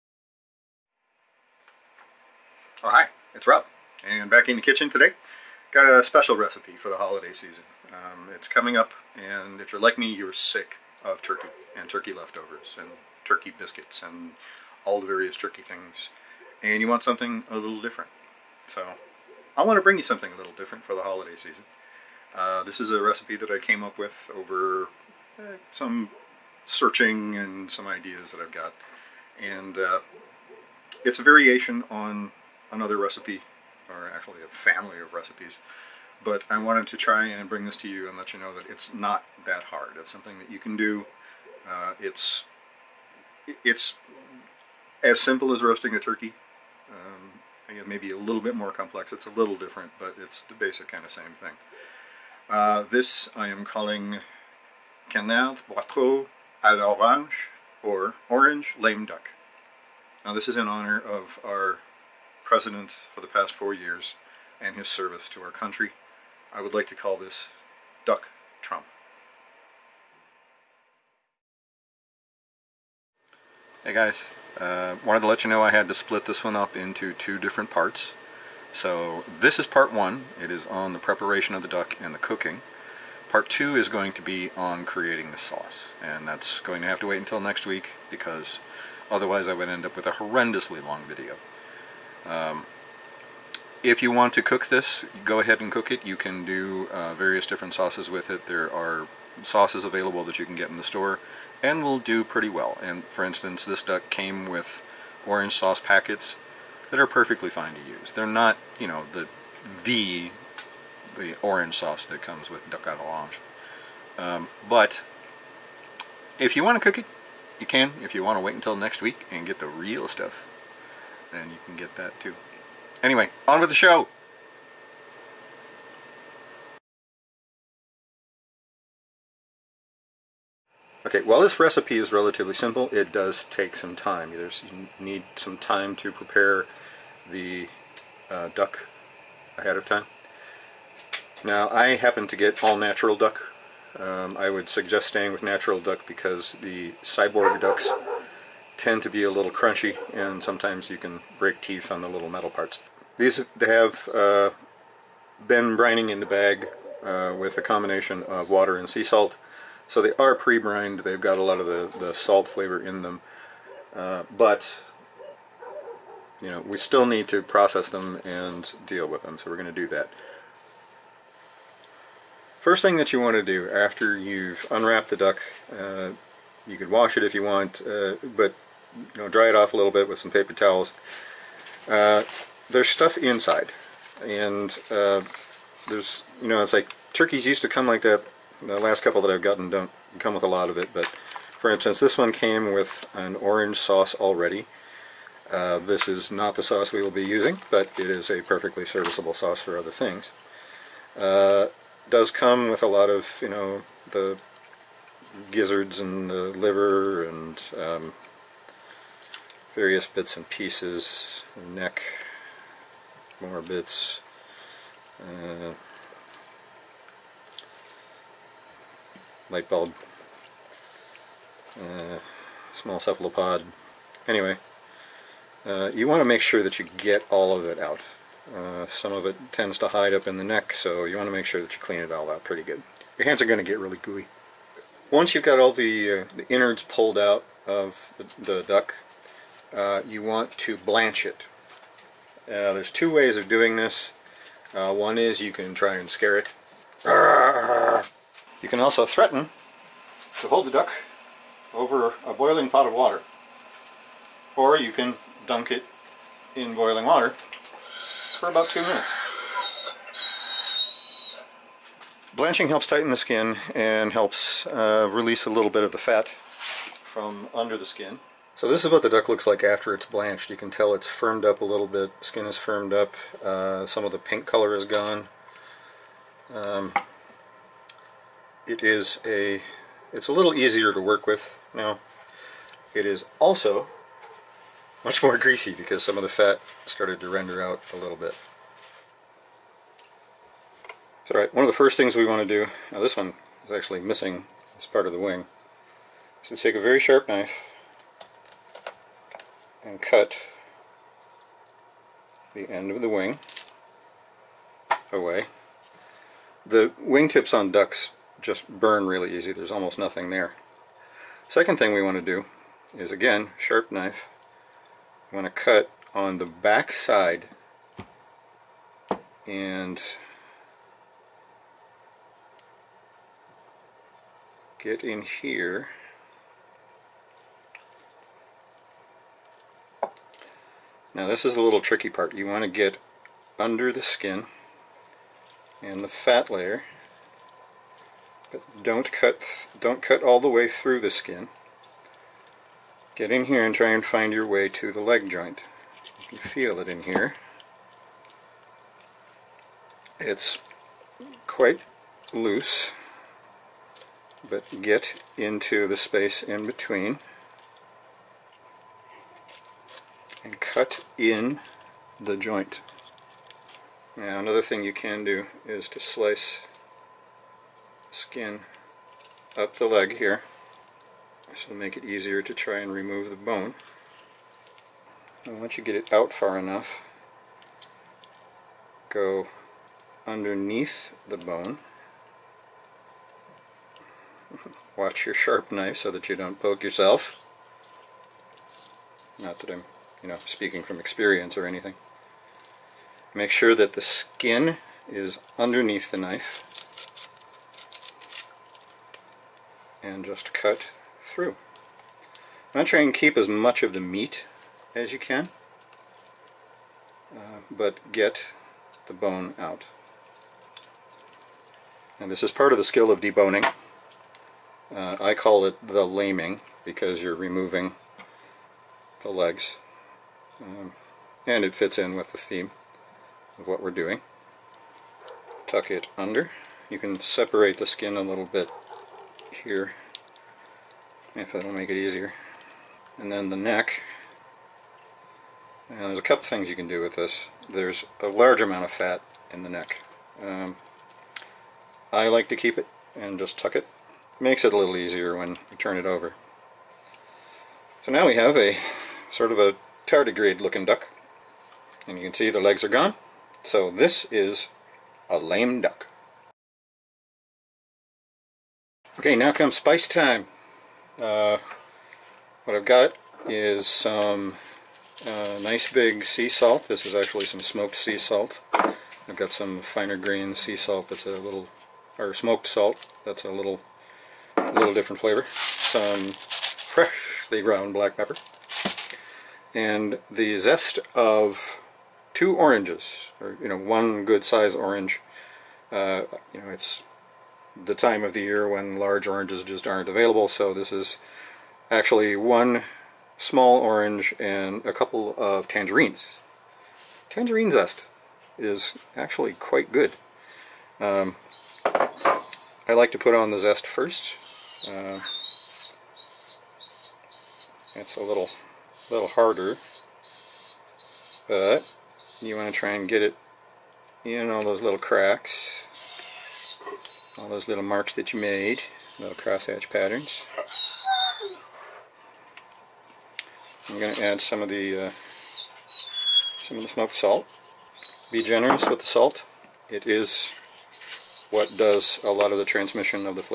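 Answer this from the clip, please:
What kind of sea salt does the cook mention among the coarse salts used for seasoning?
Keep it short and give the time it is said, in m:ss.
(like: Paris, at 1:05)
smoked sea salt, at 7:47.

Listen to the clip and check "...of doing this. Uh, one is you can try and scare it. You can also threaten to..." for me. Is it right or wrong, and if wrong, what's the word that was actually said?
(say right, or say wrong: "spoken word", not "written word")
right.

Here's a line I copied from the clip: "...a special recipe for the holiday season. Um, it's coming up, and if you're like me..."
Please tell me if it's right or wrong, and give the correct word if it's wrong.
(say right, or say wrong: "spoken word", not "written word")
right.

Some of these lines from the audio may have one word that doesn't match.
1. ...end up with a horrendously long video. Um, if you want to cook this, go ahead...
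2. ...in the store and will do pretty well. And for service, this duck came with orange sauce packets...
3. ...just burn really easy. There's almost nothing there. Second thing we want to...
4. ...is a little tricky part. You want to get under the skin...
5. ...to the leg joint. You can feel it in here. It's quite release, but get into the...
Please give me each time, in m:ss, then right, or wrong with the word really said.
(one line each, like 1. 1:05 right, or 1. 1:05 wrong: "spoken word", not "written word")
1. 1:29 right
2. 1:40 wrong: "instance", not "service"
3. 5:08 right
4. 5:31 right
5. 5:44 wrong: "loose", not "release".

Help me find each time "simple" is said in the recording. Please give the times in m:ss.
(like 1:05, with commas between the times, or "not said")
0:45, 2:12.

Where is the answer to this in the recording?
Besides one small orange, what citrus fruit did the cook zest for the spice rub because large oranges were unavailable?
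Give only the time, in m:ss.
8:14.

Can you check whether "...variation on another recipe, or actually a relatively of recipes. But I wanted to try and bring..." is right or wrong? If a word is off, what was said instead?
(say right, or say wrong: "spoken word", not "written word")
wrong: "family", not "relatively".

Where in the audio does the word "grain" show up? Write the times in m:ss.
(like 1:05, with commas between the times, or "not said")
7:50.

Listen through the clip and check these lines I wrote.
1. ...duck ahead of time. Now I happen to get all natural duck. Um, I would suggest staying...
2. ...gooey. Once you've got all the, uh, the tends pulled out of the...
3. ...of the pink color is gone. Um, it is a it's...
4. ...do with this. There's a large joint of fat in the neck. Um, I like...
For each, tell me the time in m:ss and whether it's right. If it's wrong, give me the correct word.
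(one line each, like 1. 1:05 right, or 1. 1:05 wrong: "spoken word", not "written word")
1. 2:18 right
2. 3:54 wrong: "innards", not "tends"
3. 4:34 right
4. 7:16 wrong: "amount", not "joint".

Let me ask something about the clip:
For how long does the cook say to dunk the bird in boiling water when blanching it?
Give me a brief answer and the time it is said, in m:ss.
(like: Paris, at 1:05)
2 minutes, at 4:18.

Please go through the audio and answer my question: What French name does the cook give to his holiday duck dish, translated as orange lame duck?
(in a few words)
canard boiteaux à l'orange.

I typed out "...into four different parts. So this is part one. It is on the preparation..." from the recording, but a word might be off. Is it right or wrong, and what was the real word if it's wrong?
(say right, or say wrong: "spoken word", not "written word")
wrong: "two", not "four".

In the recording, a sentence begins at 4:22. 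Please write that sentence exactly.
Blanching helps tighten the skin and helps uh, release a little bit of the fat from under the skin.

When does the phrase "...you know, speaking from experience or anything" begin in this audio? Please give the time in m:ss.
6:30.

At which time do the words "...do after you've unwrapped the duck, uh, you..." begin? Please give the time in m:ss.
2:53.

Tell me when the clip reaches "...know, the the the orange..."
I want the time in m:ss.
1:48.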